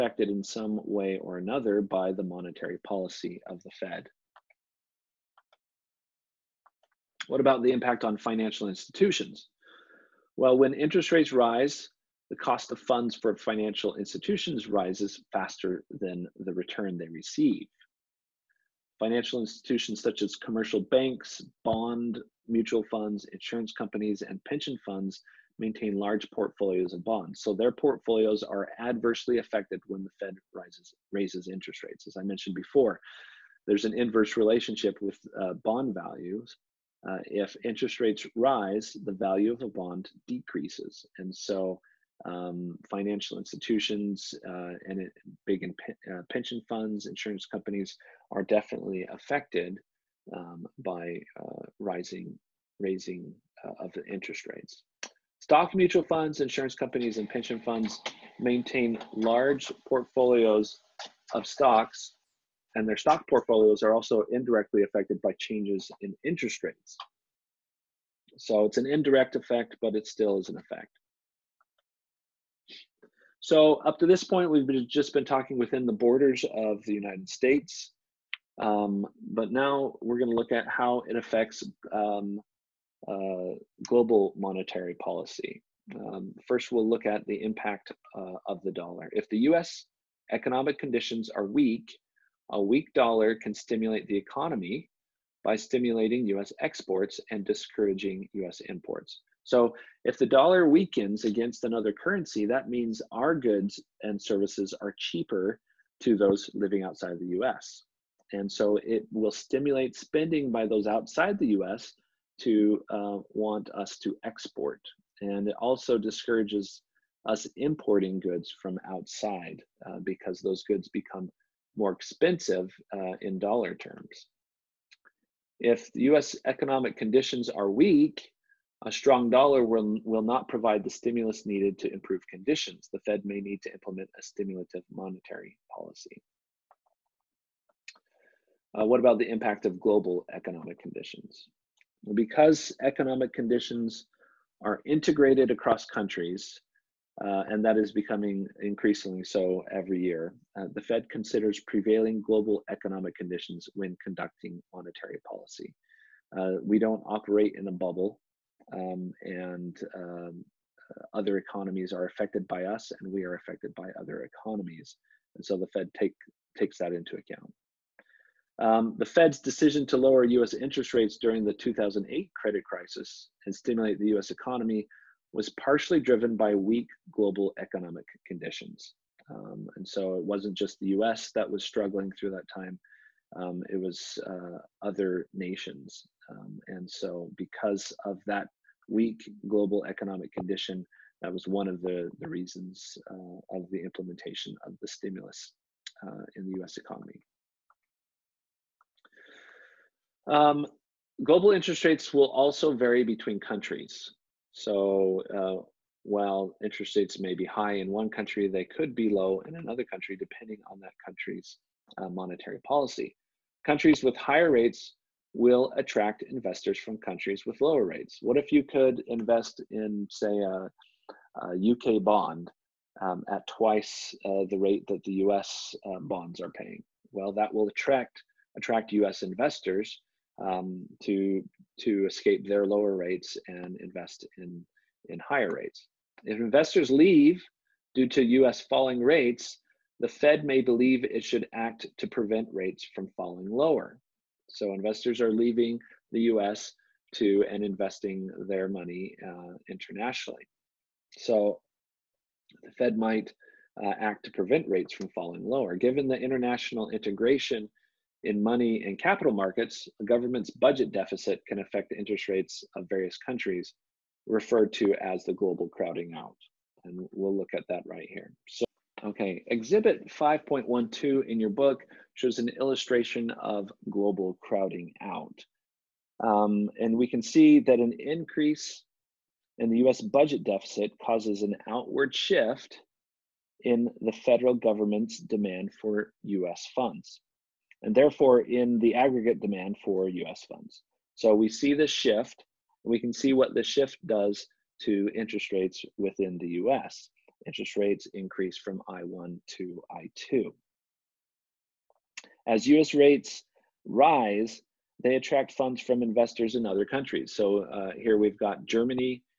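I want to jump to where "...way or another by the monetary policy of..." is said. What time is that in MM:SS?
00:00.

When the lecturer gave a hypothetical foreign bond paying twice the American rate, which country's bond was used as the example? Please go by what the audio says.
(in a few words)
UK.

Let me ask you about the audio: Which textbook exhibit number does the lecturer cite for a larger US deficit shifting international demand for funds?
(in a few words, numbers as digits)
5.12.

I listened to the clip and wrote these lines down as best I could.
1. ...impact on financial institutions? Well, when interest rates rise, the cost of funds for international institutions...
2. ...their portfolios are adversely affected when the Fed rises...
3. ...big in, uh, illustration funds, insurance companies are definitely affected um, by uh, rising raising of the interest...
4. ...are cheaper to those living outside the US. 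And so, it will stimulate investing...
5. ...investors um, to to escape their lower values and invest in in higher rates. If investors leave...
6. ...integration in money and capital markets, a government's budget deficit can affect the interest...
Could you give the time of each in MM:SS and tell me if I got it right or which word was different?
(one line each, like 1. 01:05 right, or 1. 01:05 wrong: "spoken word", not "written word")
1. 00:07 wrong: "financial", not "international"
2. 00:27 right
3. 00:45 wrong: "pension", not "illustration"
4. 01:44 wrong: "spending", not "investing"
5. 03:49 wrong: "rates", not "values"
6. 04:16 right.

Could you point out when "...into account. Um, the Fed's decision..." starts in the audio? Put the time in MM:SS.
02:46.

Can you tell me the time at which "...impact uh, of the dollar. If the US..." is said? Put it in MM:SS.
01:27.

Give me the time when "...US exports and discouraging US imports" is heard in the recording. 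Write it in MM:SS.
01:36.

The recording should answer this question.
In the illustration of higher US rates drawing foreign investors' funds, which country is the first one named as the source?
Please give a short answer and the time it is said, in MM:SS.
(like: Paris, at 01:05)
Germany, at 05:08.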